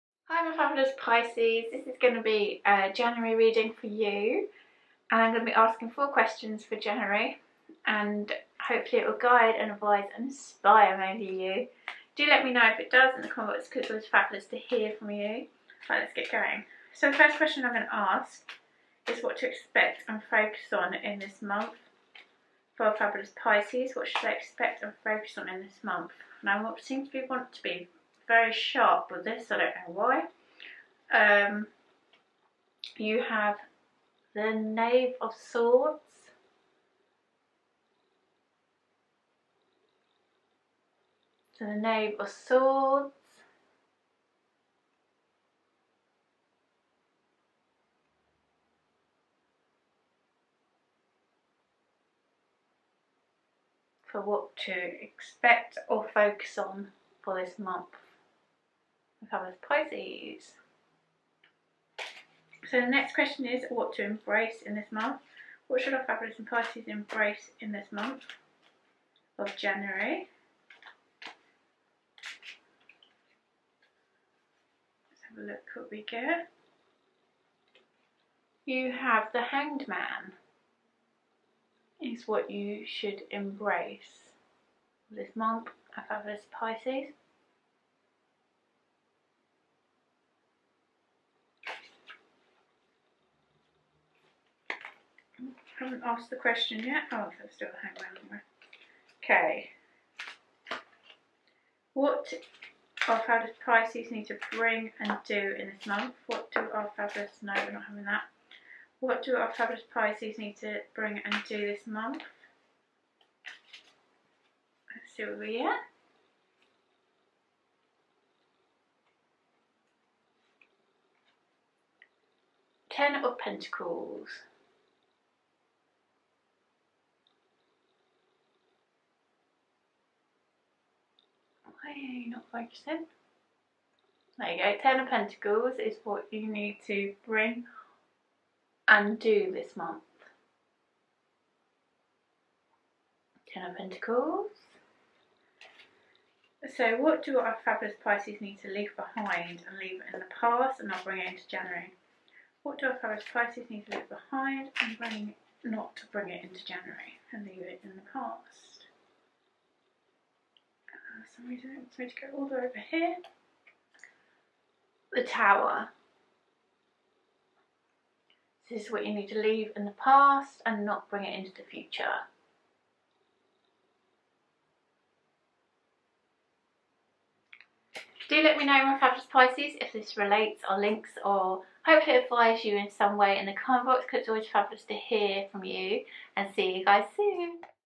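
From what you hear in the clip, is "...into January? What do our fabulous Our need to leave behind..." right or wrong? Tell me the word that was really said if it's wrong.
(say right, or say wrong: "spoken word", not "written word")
wrong: "Pisces", not "Our".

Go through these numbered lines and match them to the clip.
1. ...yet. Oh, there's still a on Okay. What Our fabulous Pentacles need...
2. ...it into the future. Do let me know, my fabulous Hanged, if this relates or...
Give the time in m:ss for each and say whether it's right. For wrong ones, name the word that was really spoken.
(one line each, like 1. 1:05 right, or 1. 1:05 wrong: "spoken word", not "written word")
1. 1:36 wrong: "Pisces", not "Pentacles"
2. 2:51 wrong: "Pisces", not "Hanged".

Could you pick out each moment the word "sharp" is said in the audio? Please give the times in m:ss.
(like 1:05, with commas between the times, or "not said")
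0:28.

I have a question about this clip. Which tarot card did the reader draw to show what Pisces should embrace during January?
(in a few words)
The Hanged Man.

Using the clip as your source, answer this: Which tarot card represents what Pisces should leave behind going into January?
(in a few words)
The Tower.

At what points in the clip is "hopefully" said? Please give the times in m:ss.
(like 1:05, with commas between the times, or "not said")
0:08, 3:01.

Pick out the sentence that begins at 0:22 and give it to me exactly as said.
For fabulous Pisces, what should they expect and focus on in this month?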